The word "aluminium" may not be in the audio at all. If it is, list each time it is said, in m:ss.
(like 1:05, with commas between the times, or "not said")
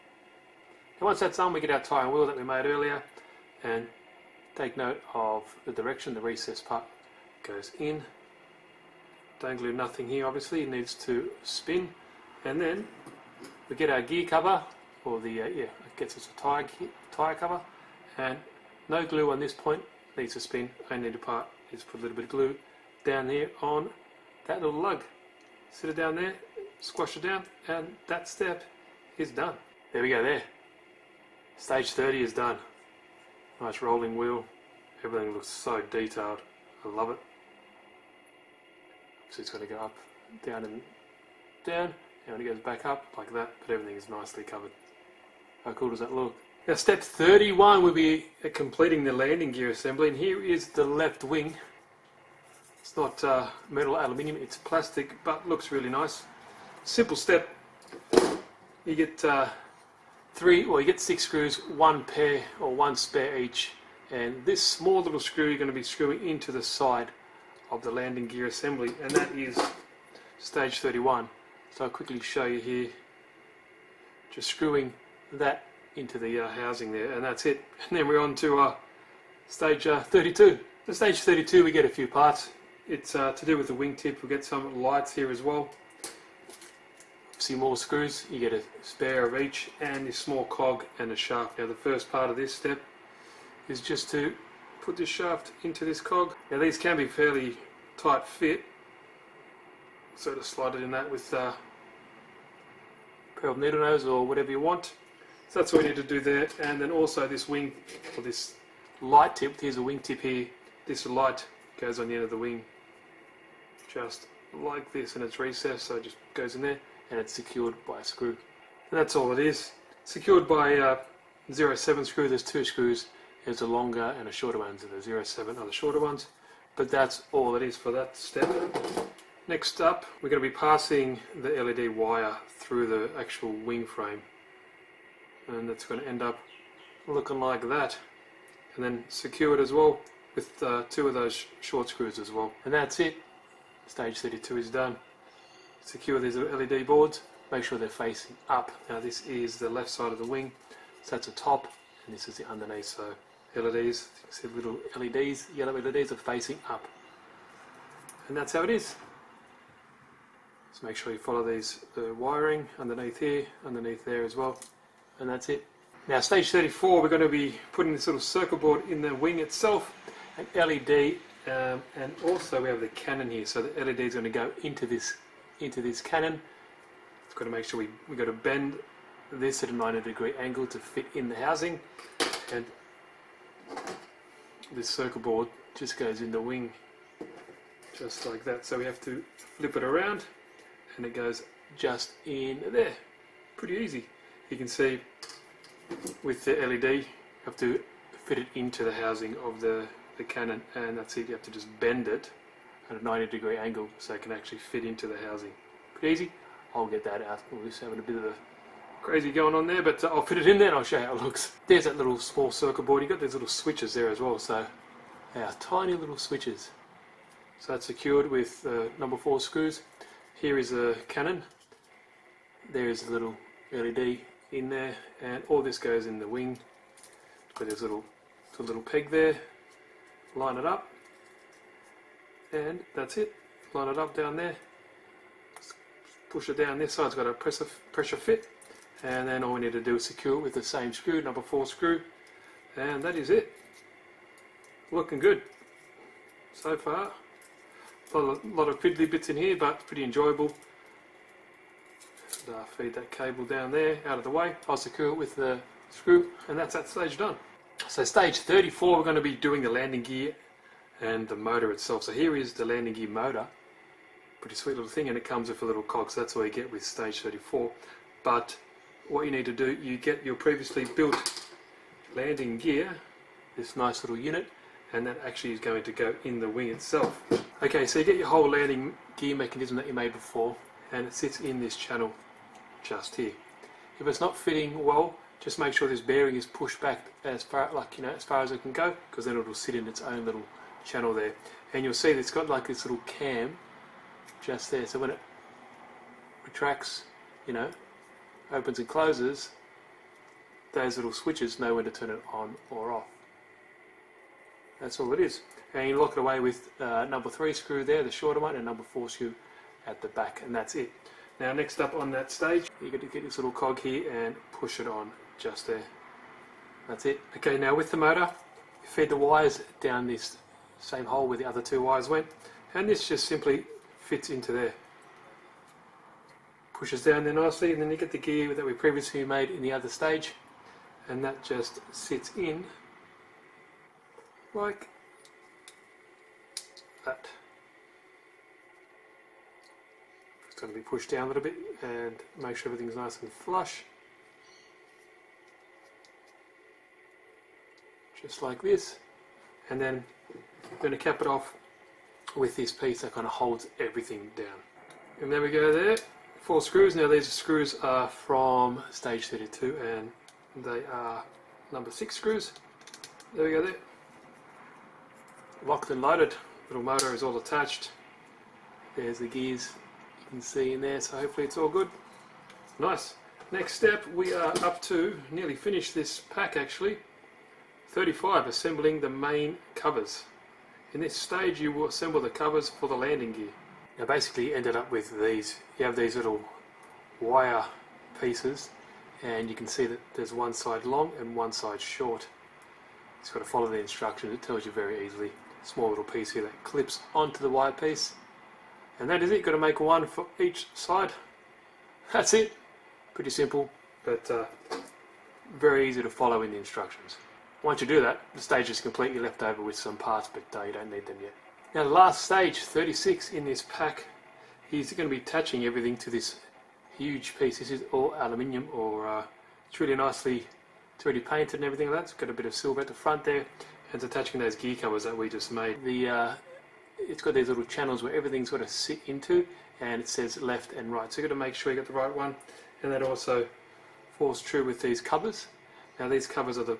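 0:53, 6:58.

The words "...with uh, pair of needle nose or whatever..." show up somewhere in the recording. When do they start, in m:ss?
1:41.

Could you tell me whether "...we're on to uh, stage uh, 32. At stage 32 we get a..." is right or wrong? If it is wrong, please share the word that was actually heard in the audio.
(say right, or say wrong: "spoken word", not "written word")
right.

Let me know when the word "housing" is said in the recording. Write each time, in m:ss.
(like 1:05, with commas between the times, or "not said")
1:16, 3:01, 3:18, 3:25.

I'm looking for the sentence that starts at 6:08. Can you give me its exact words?
There's the gears you can see in there, so hopefully it's all good.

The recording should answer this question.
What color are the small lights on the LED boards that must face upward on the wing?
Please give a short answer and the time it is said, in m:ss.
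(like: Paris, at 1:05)
yellow, at 2:35.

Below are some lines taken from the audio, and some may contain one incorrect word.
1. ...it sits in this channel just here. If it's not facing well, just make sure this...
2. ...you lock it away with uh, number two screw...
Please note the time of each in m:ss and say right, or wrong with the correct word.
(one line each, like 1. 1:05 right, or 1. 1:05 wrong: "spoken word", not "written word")
1. 4:41 wrong: "fitting", not "facing"
2. 5:05 wrong: "three", not "two".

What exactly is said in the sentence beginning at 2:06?
But that's all it is for that step.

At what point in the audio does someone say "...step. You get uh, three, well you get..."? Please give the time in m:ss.
0:57.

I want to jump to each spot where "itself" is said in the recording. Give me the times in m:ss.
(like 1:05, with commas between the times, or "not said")
2:49, 4:21, 4:36.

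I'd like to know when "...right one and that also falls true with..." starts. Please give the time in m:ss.
7:11.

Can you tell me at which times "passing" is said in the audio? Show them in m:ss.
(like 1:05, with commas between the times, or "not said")
2:10.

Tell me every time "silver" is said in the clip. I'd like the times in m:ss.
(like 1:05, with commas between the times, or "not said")
7:02.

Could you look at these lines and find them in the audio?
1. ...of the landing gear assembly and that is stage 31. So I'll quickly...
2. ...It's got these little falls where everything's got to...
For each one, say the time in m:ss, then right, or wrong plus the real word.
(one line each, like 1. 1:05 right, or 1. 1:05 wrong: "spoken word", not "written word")
1. 1:07 right
2. 7:06 wrong: "channels", not "falls".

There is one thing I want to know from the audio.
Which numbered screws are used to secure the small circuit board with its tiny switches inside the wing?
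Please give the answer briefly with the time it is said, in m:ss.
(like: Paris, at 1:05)
number 4, at 3:38.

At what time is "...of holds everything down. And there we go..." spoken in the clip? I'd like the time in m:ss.
5:53.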